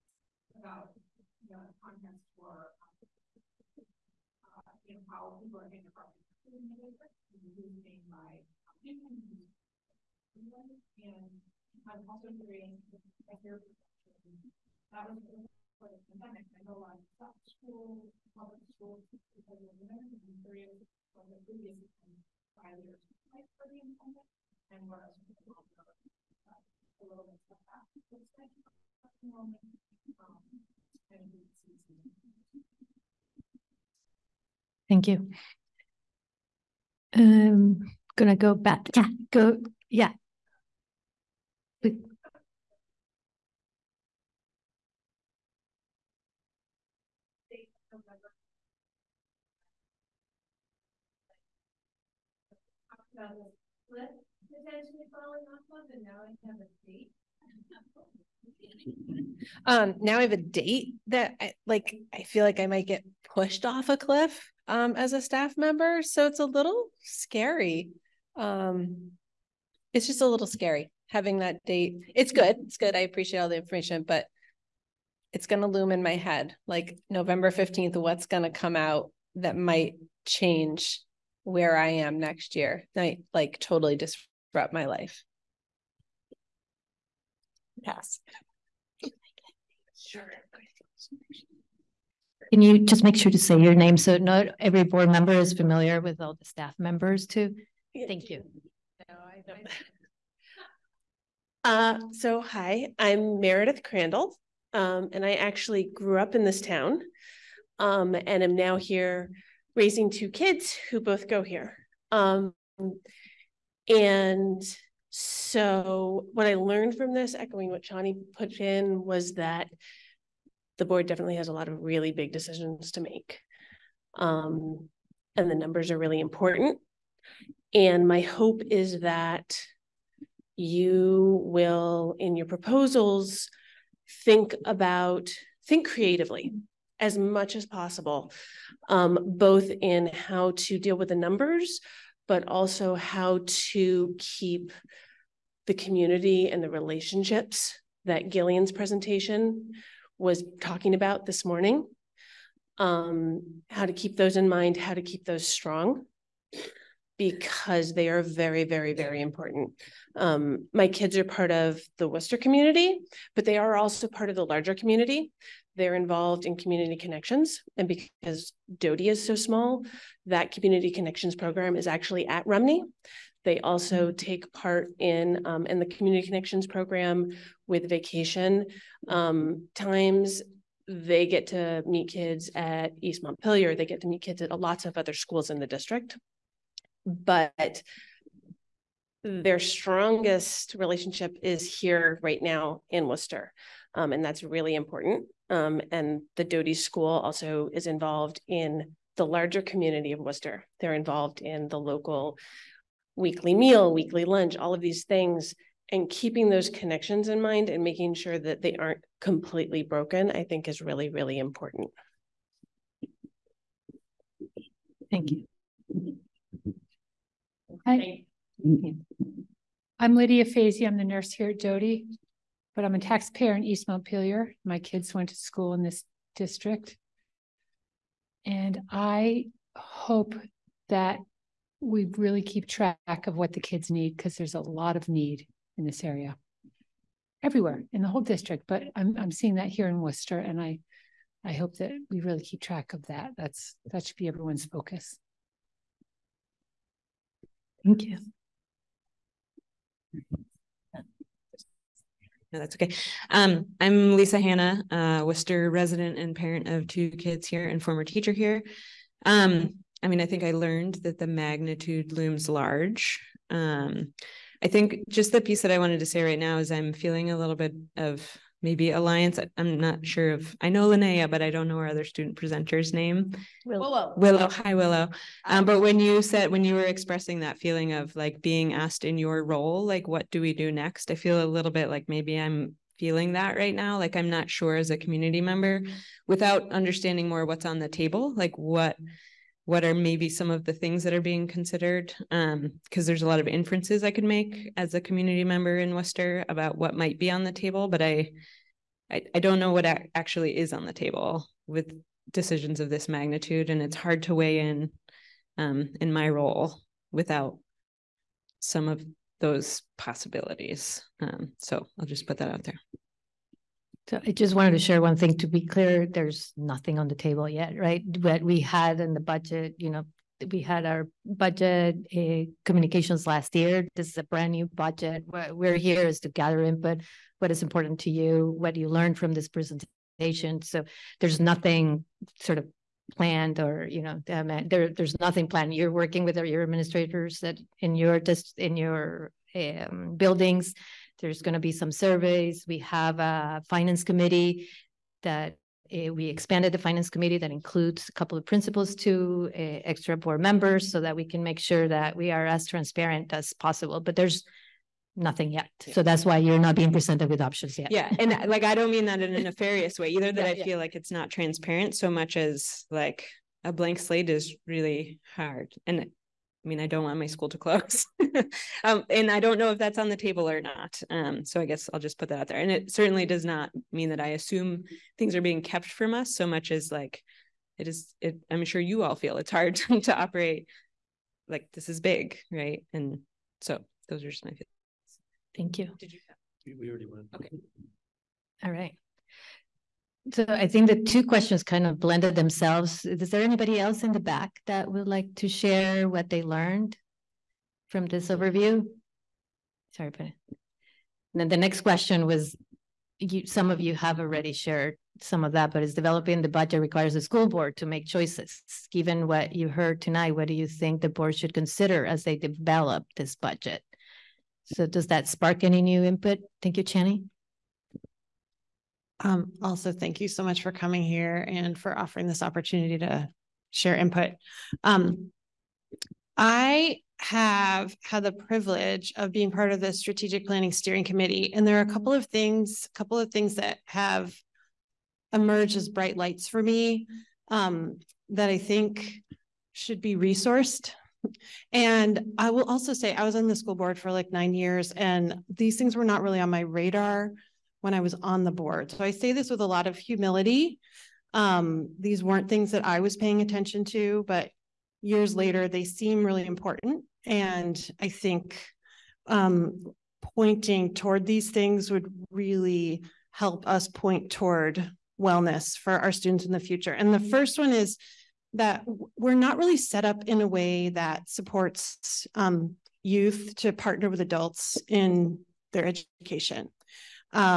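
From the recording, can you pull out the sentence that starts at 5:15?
To be clear, there's nothing on the table yet, right?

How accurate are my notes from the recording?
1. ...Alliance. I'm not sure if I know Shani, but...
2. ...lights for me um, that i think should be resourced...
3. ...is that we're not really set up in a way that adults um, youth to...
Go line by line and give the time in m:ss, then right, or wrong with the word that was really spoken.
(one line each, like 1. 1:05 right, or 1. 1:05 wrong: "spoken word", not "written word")
1. 4:28 wrong: "Linnea", not "Shani"
2. 7:16 right
3. 7:47 wrong: "supports", not "adults".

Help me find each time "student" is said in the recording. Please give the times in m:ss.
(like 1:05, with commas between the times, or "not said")
4:32, 7:46.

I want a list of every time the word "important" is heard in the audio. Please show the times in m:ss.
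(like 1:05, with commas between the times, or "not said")
2:06, 2:39, 3:14, 3:31, 5:27, 7:36.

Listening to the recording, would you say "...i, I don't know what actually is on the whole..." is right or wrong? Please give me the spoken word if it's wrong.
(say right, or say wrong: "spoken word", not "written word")
wrong: "table", not "whole".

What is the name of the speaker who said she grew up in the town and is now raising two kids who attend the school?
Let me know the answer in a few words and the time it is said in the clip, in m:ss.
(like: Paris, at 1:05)
Meredith Crandall, at 1:43.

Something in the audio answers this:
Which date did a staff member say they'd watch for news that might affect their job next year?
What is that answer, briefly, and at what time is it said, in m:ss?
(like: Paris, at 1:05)
November 15th, at 1:17.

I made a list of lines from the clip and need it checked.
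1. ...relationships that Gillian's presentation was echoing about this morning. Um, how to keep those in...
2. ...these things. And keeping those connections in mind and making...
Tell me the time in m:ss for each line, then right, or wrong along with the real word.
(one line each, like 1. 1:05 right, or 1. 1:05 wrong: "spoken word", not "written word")
1. 2:26 wrong: "talking", not "echoing"
2. 3:24 right.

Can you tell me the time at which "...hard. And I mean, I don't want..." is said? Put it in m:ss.
6:05.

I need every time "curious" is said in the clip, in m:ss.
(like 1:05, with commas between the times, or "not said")
0:12, 0:20.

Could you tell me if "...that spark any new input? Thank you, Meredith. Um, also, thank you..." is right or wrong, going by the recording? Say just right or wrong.
wrong.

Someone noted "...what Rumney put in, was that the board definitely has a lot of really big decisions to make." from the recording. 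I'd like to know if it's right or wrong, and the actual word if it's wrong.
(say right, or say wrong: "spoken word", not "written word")
wrong: "Shani", not "Rumney".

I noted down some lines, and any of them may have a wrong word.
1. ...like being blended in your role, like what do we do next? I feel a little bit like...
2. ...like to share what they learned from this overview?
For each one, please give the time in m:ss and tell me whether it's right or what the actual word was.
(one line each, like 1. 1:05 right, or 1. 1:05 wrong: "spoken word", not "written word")
1. 4:38 wrong: "asked", not "blended"
2. 6:35 right.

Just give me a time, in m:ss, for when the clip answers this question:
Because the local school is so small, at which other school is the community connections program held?
2:52.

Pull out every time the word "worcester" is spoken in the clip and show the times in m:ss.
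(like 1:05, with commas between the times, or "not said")
2:42, 3:13, 3:20, 4:00, 4:15, 4:55.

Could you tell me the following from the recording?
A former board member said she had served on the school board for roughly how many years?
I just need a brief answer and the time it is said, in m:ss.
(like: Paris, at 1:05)
9, at 7:24.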